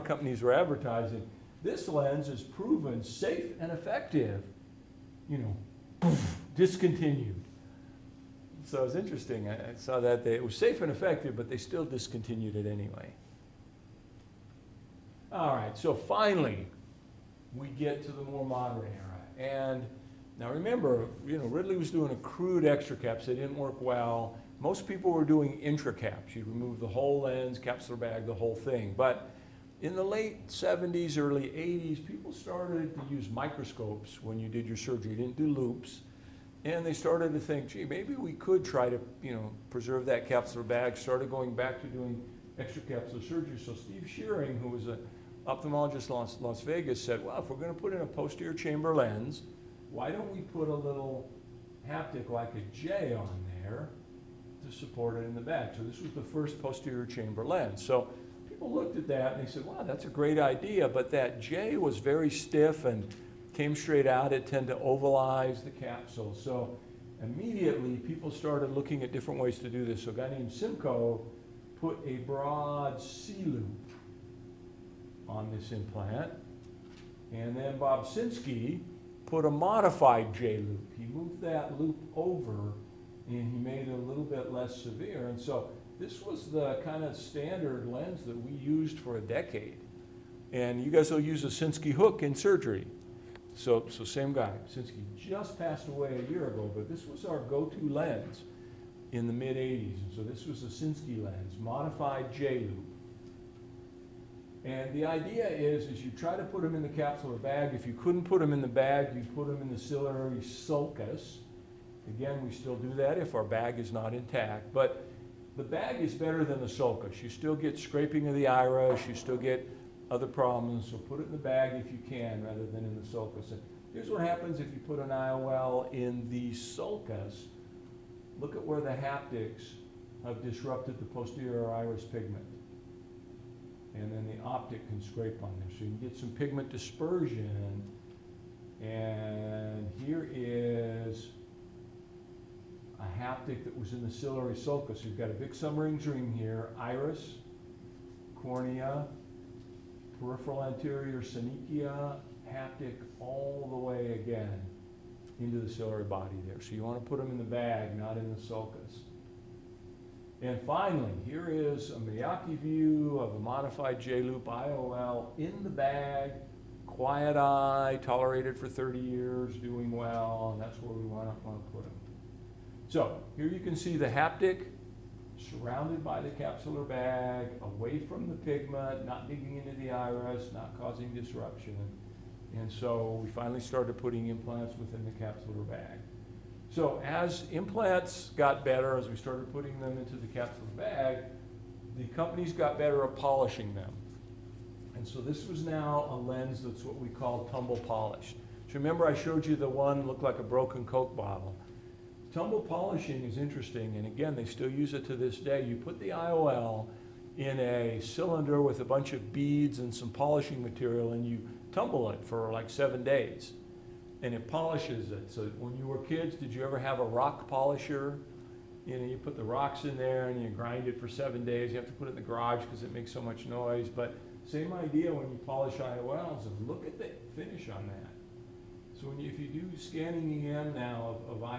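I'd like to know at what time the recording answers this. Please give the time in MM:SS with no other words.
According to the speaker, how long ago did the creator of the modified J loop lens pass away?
01:36.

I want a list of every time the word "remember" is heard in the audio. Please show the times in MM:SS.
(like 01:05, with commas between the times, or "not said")
00:20, 03:18.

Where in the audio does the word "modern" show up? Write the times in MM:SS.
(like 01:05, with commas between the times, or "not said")
00:18.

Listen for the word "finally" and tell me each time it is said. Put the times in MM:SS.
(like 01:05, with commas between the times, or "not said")
00:15, 02:40, 03:03.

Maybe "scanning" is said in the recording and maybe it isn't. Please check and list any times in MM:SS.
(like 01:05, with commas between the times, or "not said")
03:49.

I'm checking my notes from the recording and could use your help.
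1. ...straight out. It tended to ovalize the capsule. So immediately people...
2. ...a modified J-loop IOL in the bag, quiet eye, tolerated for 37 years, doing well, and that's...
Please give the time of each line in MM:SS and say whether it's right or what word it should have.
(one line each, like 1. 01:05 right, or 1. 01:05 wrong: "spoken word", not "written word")
1. 01:03 right
2. 02:43 wrong: "30", not "37".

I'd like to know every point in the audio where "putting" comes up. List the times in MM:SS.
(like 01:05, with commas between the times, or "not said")
03:03, 03:09.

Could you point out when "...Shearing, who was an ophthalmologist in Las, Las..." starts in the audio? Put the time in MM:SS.
00:44.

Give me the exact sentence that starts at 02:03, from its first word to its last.
And here's what happens if you put an IOL in the sulcus.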